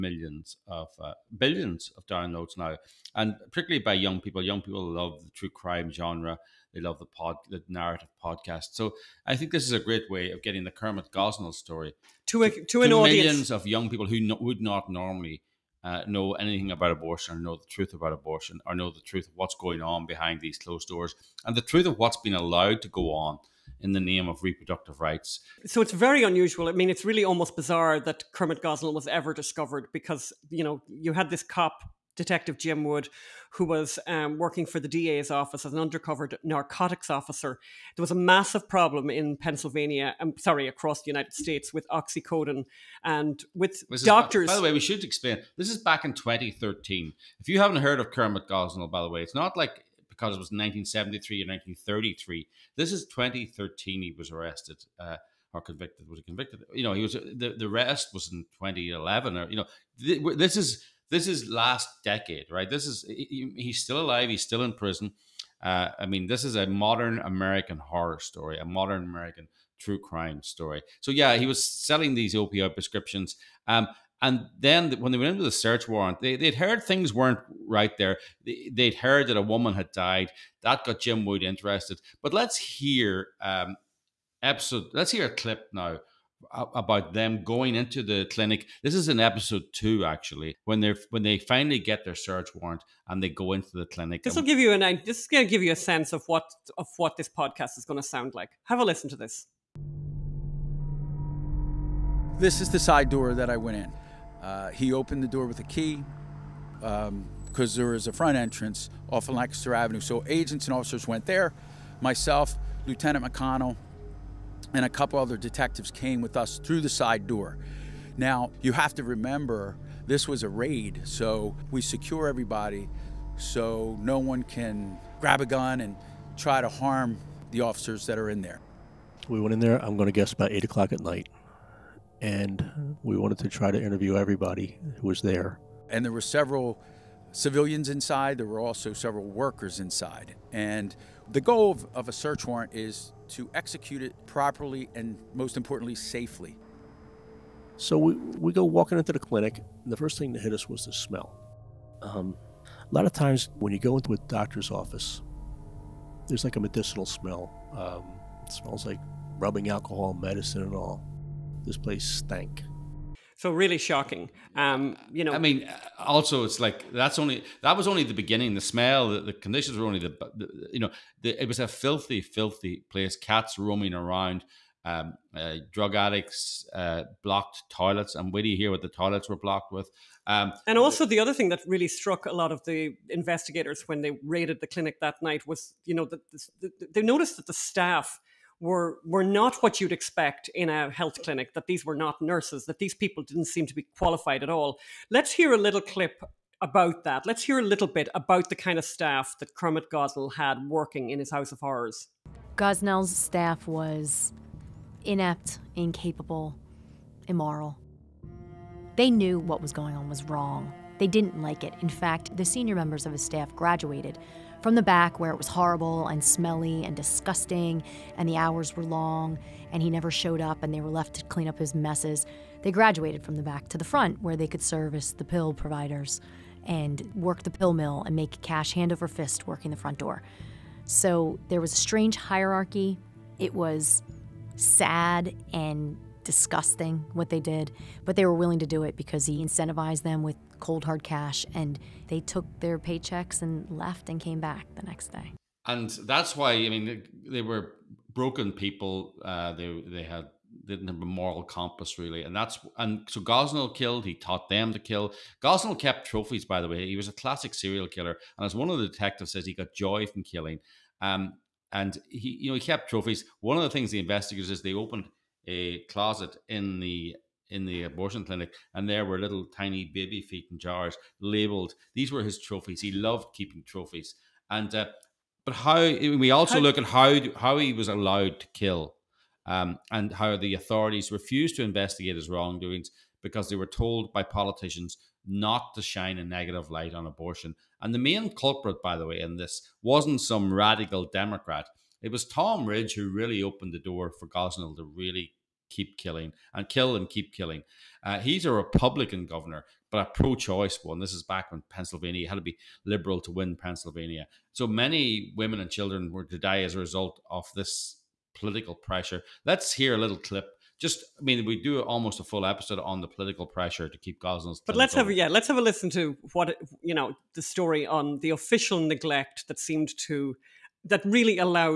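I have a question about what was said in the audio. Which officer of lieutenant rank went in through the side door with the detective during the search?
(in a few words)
Lieutenant McConnell.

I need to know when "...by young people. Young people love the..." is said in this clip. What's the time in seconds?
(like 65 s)
3 s.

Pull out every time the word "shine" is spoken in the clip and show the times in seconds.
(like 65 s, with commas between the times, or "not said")
285 s.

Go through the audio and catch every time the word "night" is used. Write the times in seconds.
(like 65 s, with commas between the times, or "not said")
130 s, 185 s.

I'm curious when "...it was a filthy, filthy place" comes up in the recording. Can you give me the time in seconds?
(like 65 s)
171 s.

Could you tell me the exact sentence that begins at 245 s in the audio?
And that's why I mean they were broken people.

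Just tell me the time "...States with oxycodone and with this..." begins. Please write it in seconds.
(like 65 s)
41 s.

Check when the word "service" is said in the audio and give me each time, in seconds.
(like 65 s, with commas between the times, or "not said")
224 s.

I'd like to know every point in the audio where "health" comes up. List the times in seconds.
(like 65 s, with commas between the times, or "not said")
190 s.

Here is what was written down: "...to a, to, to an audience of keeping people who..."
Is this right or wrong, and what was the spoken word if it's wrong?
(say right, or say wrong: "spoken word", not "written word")
wrong: "young", not "keeping".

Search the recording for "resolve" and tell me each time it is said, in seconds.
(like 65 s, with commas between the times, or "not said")
not said.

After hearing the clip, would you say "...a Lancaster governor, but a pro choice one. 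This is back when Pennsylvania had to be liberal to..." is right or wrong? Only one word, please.
wrong.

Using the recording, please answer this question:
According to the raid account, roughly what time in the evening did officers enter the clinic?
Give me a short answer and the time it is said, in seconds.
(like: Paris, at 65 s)
8 o'clock, at 130 s.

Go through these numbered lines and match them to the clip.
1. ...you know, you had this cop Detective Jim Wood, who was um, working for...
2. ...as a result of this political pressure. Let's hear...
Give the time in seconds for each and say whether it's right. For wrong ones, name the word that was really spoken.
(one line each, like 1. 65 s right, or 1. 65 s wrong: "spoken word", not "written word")
1. 30 s right
2. 306 s right.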